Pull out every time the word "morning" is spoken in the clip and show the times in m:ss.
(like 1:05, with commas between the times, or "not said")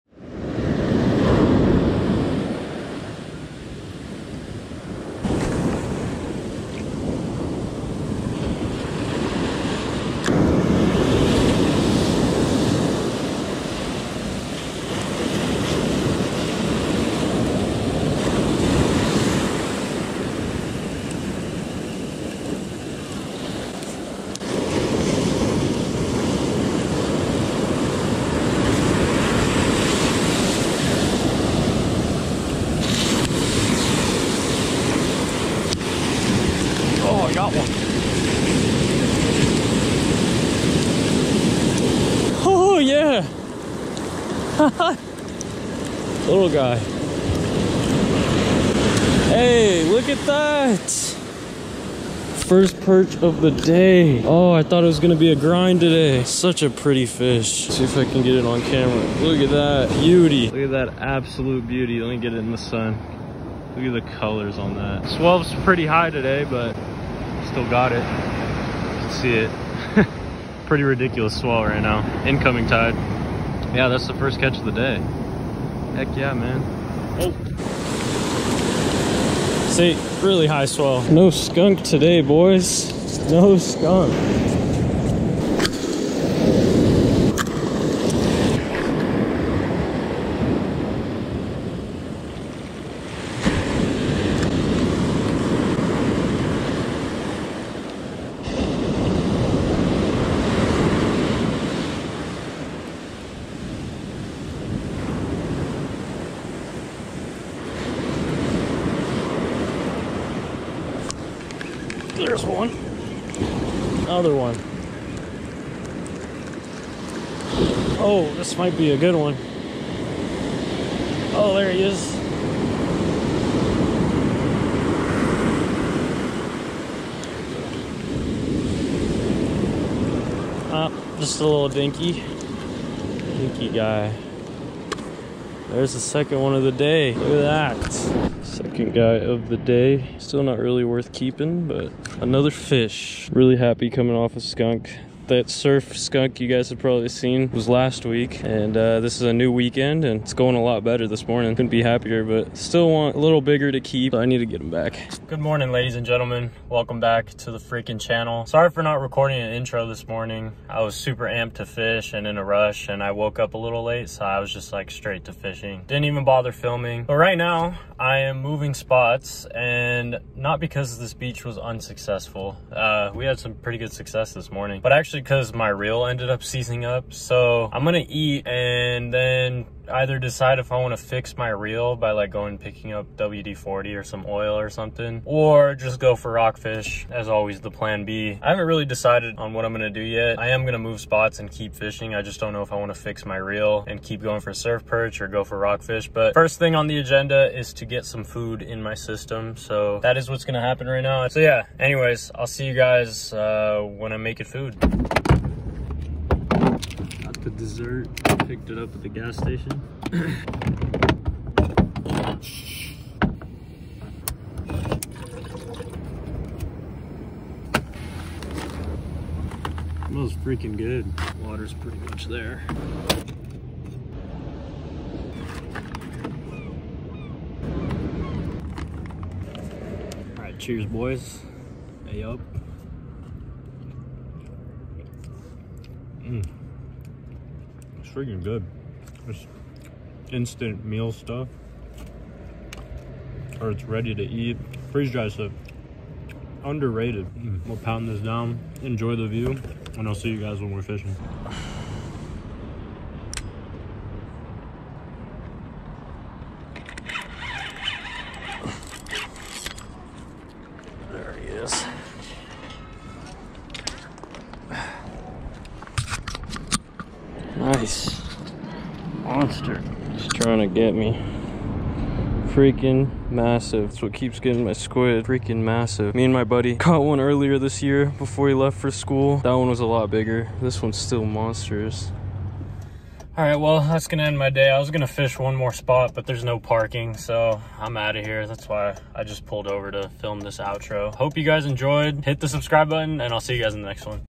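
2:31, 2:35, 2:40, 2:54.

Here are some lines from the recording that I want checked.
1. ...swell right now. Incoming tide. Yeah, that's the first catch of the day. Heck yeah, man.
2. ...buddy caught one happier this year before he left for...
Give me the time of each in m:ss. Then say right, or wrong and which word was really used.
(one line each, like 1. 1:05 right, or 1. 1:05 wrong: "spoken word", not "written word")
1. 1:11 right
2. 4:36 wrong: "earlier", not "happier".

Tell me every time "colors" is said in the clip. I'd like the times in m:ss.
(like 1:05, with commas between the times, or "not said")
1:04.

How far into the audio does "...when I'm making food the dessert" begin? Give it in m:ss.
3:23.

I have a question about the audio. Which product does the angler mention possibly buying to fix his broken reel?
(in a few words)
WD-40.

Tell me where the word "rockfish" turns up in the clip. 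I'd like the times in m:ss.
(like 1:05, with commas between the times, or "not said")
3:06, 3:15.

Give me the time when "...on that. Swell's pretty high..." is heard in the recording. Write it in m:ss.
1:04.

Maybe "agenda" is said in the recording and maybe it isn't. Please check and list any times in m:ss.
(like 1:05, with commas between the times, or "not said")
3:16.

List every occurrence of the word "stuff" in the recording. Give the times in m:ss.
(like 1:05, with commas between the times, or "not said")
4:01, 4:05.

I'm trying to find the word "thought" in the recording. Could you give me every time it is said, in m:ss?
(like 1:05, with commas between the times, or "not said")
0:54.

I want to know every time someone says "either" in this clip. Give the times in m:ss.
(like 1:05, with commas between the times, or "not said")
2:59.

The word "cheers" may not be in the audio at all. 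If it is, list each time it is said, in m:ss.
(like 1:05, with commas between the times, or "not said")
3:50.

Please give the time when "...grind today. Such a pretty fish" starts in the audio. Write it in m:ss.
0:55.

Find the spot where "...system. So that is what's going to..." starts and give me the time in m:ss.
3:18.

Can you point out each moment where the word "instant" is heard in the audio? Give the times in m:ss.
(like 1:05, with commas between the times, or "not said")
4:00.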